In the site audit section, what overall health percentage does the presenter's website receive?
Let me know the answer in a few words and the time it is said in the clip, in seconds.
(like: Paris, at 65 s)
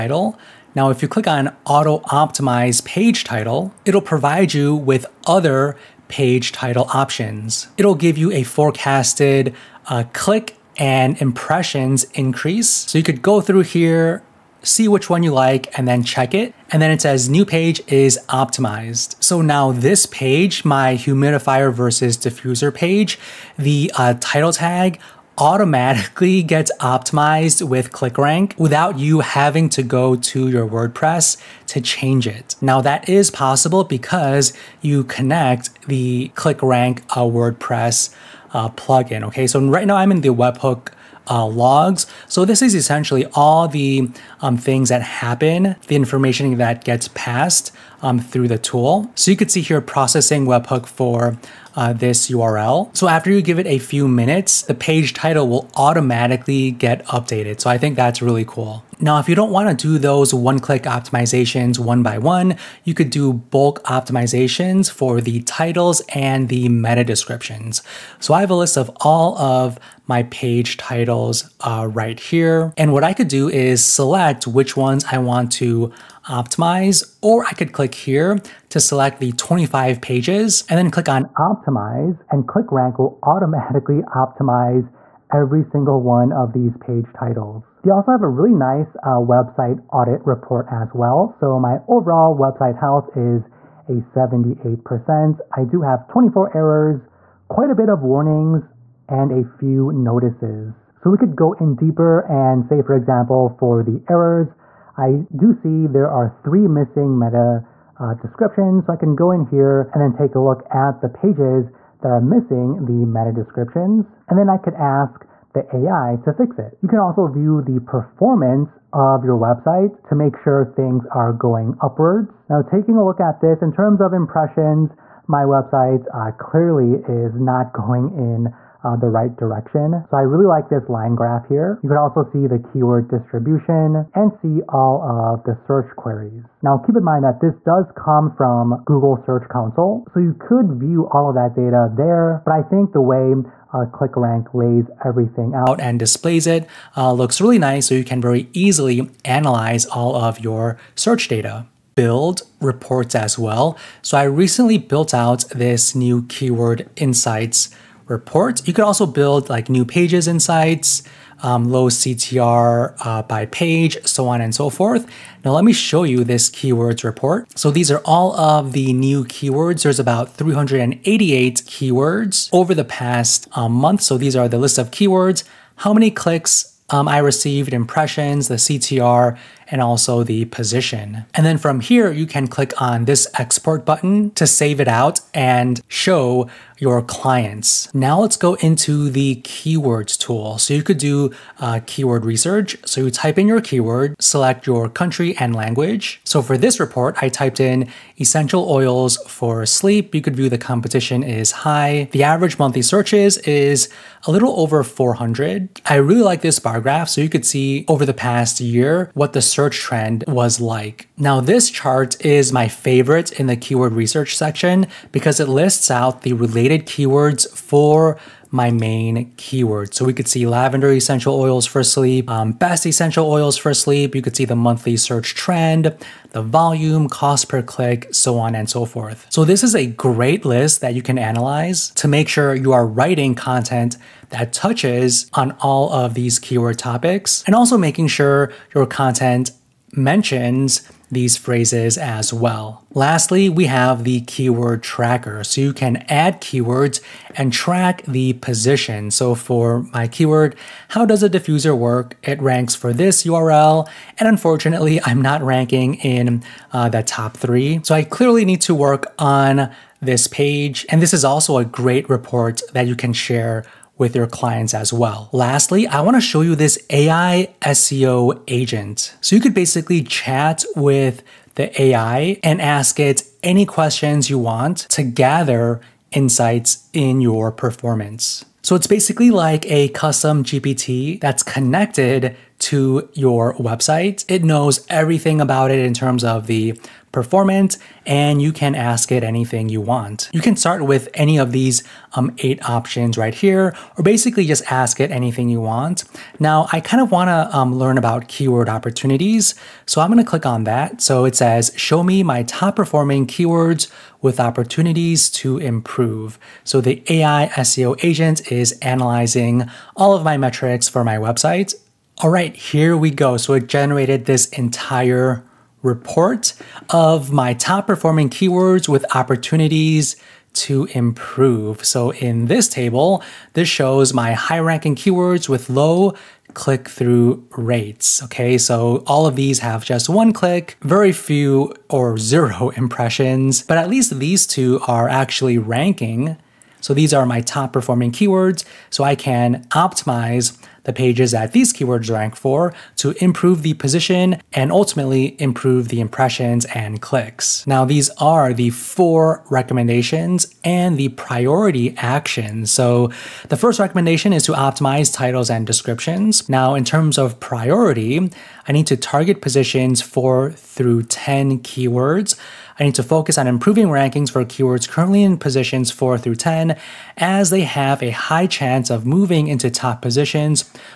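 78%, at 93 s.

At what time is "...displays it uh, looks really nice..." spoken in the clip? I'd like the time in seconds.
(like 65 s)
145 s.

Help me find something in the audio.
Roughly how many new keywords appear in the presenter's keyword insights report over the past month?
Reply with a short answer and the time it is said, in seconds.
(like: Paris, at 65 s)
388, at 170 s.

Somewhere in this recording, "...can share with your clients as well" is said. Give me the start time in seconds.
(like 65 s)
262 s.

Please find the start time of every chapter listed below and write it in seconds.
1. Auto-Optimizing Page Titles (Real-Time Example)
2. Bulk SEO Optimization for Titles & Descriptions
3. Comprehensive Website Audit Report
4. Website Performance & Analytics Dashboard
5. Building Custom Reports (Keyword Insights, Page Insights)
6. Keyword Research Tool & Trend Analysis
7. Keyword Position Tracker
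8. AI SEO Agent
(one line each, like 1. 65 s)
1. 20 s
2. 78 s
3. 108 s
4. 141 s
5. 164 s
6. 209 s
7. 274 s
8. 294 s.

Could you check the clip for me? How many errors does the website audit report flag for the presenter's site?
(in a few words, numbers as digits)
24.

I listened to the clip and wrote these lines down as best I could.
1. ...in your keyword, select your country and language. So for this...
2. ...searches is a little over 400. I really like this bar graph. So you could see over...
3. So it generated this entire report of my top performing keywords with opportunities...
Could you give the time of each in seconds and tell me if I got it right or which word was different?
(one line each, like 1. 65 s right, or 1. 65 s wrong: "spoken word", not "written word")
1. 193 s right
2. 202 s right
3. 313 s right.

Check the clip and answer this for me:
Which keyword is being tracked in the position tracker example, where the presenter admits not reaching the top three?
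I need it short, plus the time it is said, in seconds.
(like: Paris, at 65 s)
how does a diffuser work, at 250 s.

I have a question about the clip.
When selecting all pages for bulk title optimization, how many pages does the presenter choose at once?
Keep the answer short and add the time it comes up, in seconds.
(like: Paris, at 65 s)
25, at 79 s.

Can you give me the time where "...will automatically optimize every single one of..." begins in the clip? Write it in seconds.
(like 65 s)
82 s.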